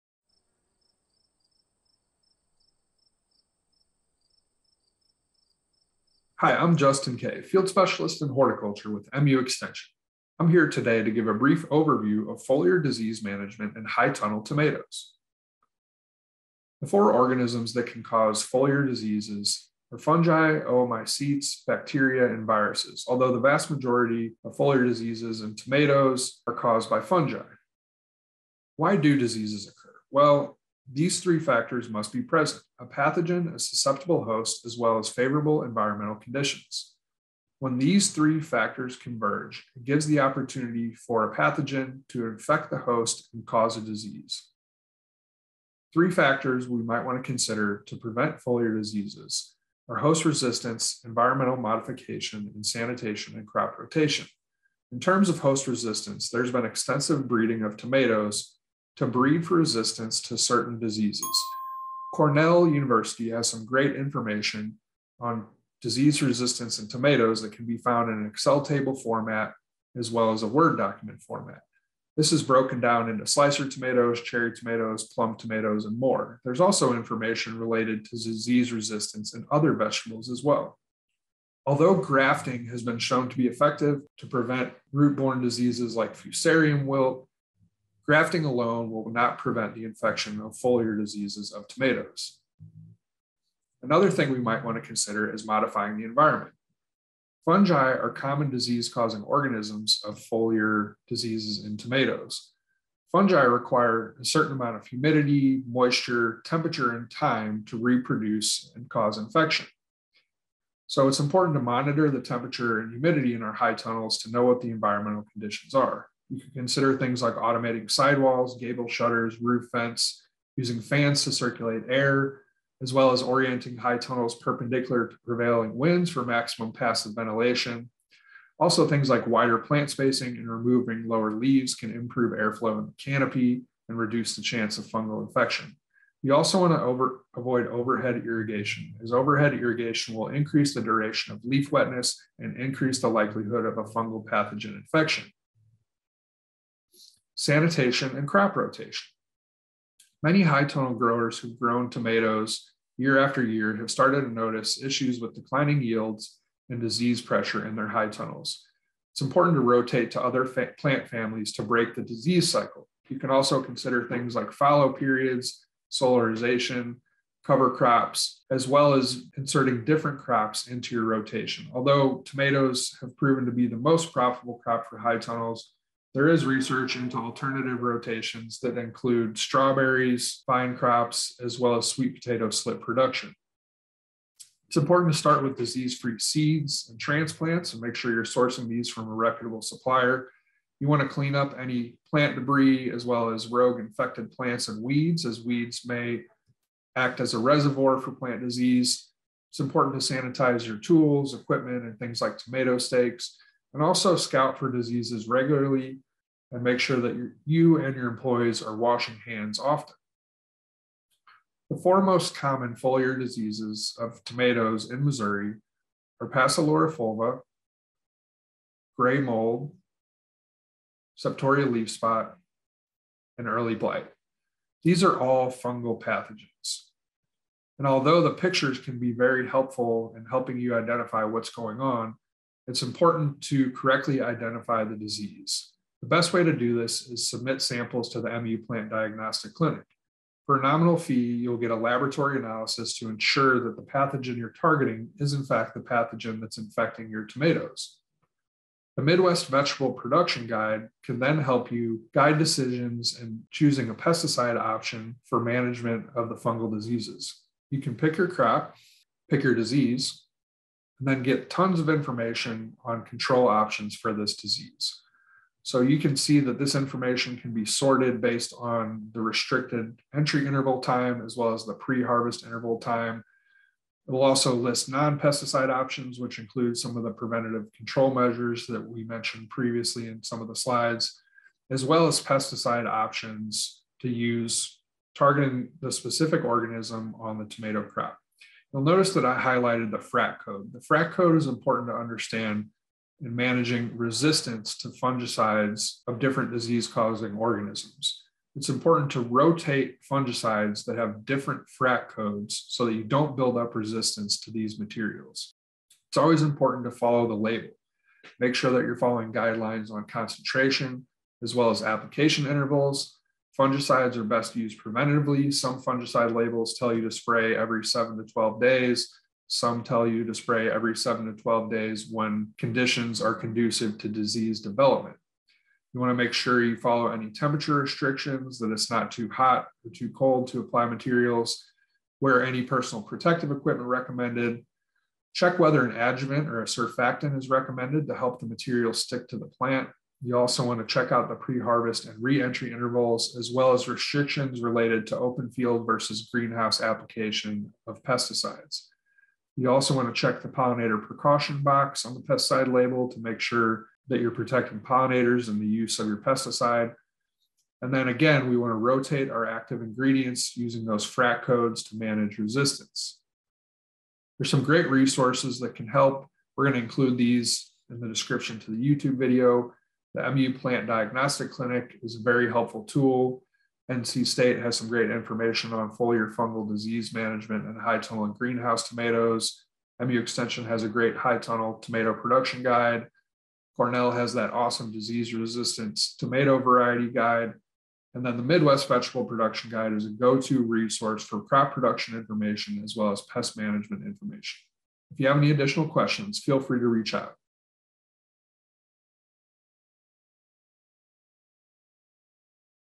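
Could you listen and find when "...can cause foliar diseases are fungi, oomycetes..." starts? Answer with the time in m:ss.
0:17.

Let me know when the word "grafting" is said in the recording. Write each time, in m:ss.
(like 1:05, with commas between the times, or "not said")
1:21, 1:28.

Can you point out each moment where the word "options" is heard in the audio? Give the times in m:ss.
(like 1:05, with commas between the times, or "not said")
4:14, 4:23, 4:35, 4:42.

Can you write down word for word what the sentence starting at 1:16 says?
There's also information related to disease resistance in other vegetables as well.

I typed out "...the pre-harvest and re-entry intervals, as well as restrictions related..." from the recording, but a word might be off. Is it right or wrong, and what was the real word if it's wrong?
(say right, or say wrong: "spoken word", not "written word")
right.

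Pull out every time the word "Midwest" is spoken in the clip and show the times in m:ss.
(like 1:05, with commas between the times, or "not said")
4:09, 6:28.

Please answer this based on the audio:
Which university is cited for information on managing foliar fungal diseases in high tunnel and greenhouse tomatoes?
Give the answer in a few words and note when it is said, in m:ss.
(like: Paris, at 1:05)
NC State, at 6:13.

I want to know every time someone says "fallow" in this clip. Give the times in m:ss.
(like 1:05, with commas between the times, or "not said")
2:44.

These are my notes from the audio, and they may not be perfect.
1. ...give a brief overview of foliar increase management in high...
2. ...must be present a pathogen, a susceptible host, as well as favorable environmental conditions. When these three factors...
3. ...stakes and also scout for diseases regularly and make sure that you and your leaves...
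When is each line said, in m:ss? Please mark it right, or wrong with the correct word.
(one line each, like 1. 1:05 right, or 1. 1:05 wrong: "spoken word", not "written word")
1. 0:11 wrong: "disease", not "increase"
2. 0:31 right
3. 3:22 wrong: "employees", not "leaves".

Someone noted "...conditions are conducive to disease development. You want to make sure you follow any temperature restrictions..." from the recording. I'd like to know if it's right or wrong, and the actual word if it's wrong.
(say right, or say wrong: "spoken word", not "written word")
right.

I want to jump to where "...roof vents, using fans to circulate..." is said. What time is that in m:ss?
1:59.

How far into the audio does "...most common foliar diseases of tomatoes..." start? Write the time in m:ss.
3:32.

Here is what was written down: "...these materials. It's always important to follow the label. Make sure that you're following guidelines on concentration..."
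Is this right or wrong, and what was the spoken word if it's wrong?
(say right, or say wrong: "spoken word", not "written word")
right.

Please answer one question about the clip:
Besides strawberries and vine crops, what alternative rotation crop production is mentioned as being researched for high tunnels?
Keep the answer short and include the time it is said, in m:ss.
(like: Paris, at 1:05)
Sweet potato slip production, at 3:01.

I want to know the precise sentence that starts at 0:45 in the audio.
Three factors we might want to consider to prevent foliar diseases are host resistance, environmental modification, and sanitation and crop rotation.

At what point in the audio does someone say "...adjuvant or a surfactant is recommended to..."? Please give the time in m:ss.
5:35.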